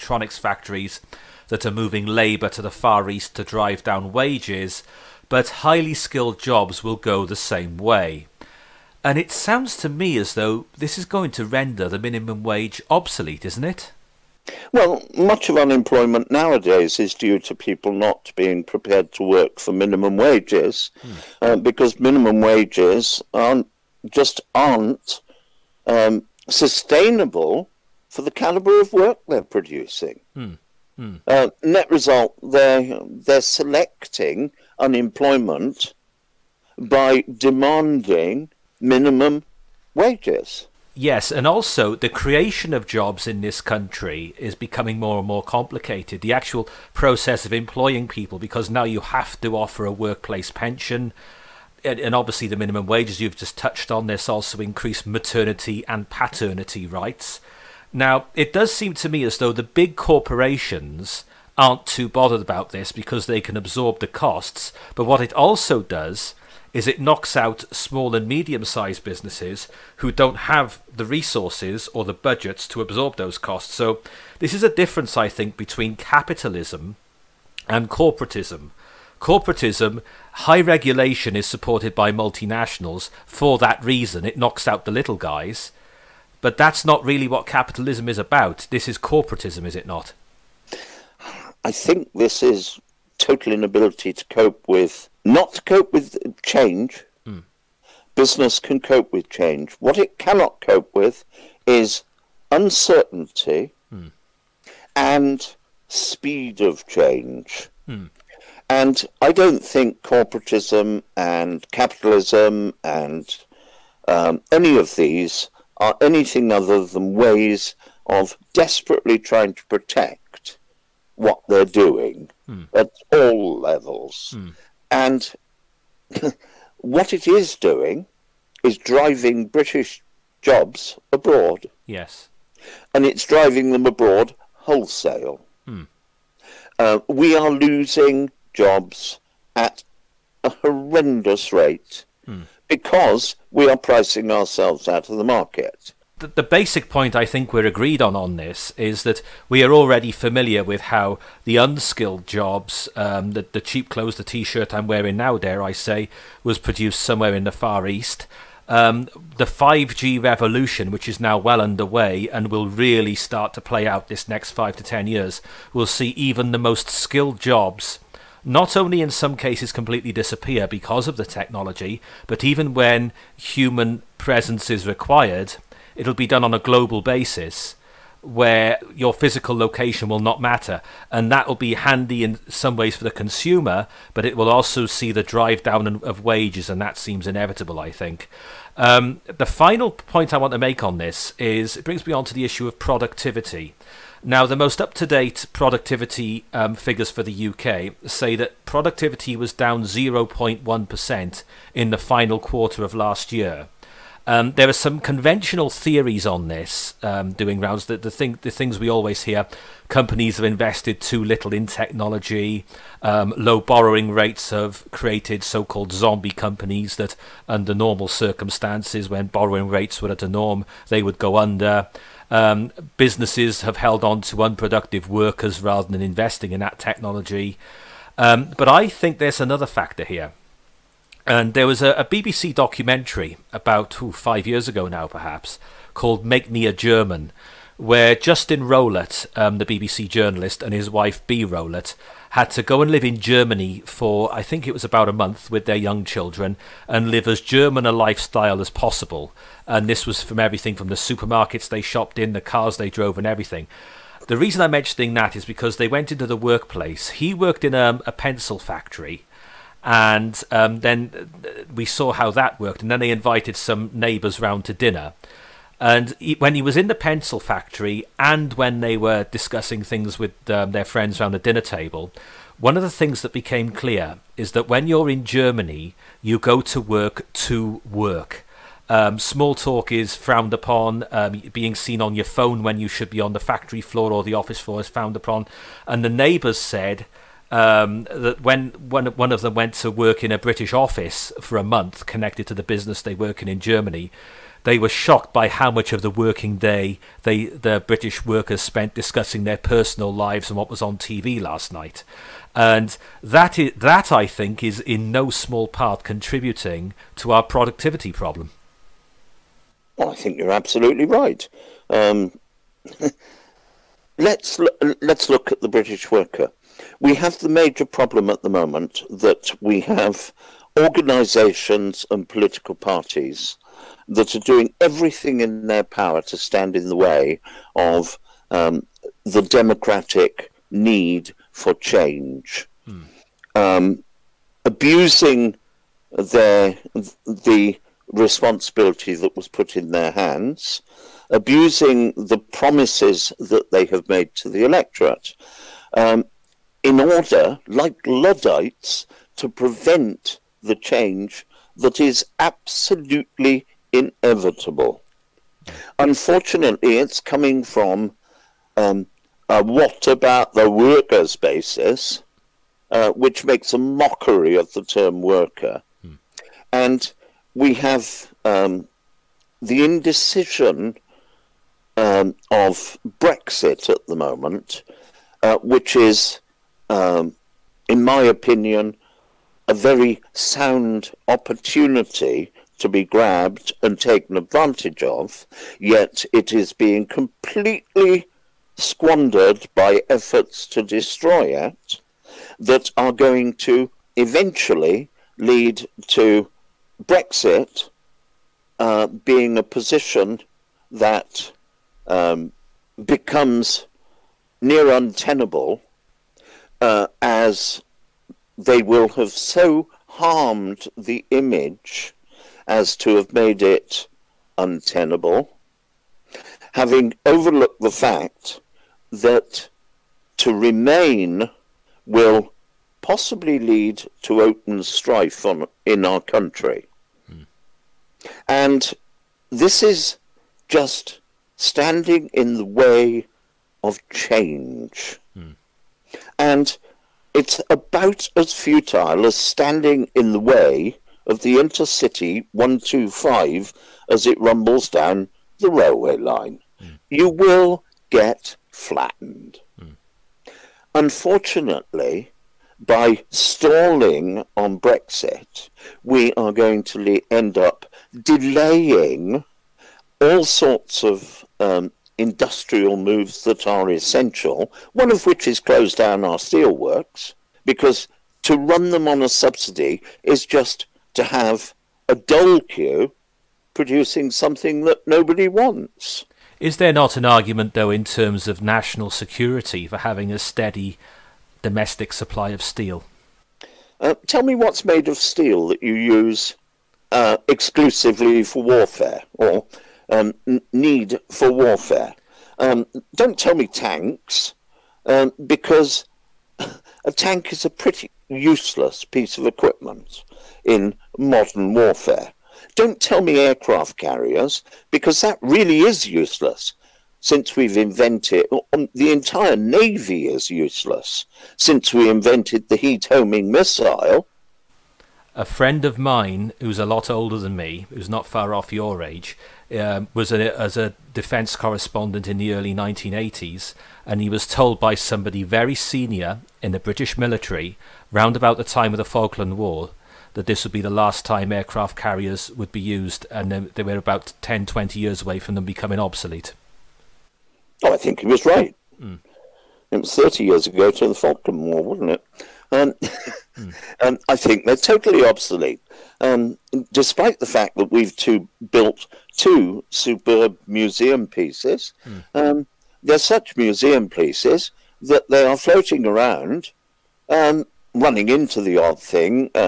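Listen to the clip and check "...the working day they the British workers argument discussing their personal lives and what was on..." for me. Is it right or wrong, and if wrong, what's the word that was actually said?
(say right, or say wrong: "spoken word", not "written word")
wrong: "spent", not "argument".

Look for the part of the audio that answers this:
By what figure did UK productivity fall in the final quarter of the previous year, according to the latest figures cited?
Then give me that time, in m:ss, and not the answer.
3:19.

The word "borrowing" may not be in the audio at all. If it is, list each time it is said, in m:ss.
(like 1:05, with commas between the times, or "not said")
3:33, 3:39.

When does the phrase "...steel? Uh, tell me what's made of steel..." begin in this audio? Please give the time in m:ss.
8:02.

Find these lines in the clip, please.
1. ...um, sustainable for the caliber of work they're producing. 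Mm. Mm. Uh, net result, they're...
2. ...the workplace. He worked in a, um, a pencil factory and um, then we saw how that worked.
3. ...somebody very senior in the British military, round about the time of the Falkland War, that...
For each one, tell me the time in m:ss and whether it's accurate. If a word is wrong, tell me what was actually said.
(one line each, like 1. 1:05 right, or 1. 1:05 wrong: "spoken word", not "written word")
1. 0:25 right
2. 4:16 right
3. 8:44 right.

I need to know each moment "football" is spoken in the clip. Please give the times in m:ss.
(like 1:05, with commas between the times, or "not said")
not said.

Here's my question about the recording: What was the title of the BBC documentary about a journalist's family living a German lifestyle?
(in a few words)
Make Me a German.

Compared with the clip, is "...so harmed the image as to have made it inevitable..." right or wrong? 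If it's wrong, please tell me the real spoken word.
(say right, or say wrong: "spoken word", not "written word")
wrong: "untenable", not "inevitable".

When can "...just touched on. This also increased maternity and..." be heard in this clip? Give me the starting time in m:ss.
0:53.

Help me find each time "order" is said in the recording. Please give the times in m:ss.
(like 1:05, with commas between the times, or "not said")
5:46.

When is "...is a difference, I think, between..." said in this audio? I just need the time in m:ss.
1:14.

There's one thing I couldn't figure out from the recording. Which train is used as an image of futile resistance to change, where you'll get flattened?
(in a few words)
Intercity 125.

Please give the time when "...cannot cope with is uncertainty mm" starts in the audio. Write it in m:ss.
1:40.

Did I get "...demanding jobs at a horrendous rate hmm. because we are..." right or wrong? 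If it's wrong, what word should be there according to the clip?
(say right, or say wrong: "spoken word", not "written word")
wrong: "losing", not "demanding".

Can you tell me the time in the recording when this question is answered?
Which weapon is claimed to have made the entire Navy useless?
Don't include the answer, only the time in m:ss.
8:32.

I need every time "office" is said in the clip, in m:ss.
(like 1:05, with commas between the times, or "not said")
4:44, 4:50.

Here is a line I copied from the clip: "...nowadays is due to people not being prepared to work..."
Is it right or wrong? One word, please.
right.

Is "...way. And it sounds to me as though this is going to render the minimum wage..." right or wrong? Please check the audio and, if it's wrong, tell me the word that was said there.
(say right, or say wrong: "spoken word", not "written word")
right.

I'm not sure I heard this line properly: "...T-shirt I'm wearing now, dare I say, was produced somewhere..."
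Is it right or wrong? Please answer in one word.
right.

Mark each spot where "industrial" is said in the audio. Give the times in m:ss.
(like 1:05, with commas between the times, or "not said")
7:42.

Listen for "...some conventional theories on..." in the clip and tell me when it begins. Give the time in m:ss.
3:24.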